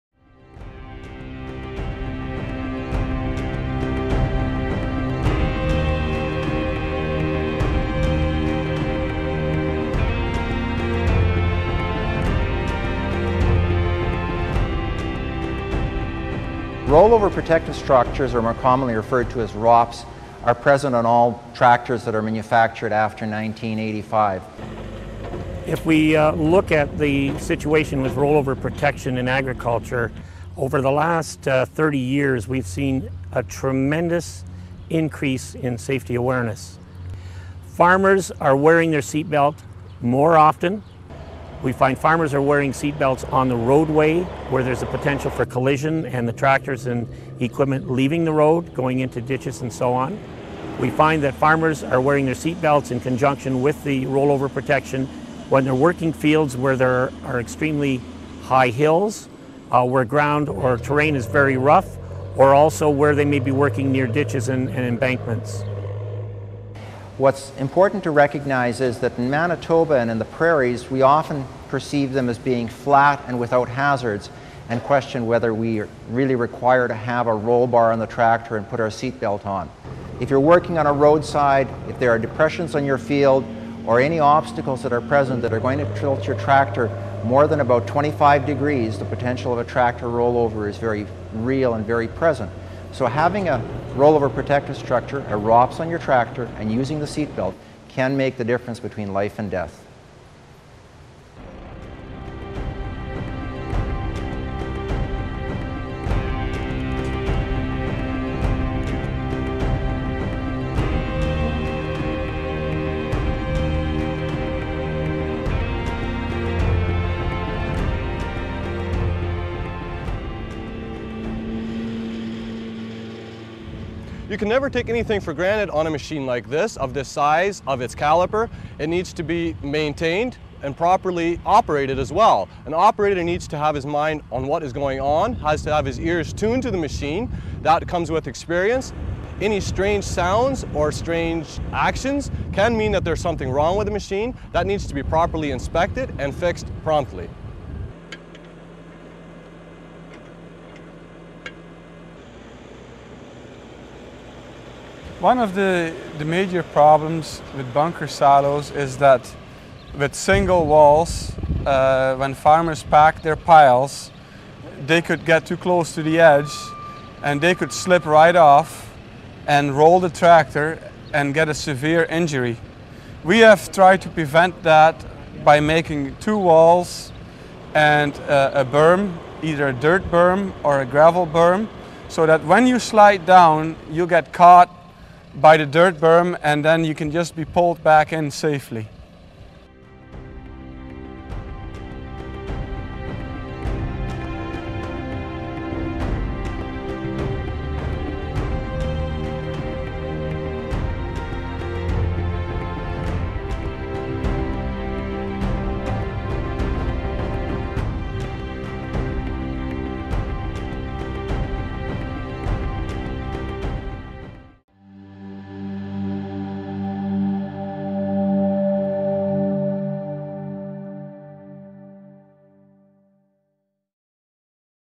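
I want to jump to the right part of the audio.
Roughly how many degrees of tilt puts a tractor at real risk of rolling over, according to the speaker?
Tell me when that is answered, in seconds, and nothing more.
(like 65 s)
87 s.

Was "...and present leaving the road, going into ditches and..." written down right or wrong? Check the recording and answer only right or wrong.
wrong.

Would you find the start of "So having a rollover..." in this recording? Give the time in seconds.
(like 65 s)
92 s.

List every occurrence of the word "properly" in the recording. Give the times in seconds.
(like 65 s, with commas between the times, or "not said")
130 s, 145 s.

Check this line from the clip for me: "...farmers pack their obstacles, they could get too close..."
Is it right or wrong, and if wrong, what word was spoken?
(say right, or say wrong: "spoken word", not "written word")
wrong: "piles", not "obstacles".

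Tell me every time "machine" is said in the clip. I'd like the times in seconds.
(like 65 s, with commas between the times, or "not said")
125 s, 136 s, 143 s.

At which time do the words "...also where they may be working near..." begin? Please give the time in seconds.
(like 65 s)
62 s.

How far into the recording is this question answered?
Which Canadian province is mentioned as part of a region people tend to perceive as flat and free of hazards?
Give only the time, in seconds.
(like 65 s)
69 s.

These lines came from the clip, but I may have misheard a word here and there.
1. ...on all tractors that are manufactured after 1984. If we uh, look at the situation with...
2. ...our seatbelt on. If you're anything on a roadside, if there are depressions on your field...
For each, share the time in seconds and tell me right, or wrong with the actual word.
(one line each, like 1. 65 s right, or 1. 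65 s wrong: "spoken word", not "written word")
1. 20 s wrong: "1985", not "1984"
2. 78 s wrong: "working", not "anything".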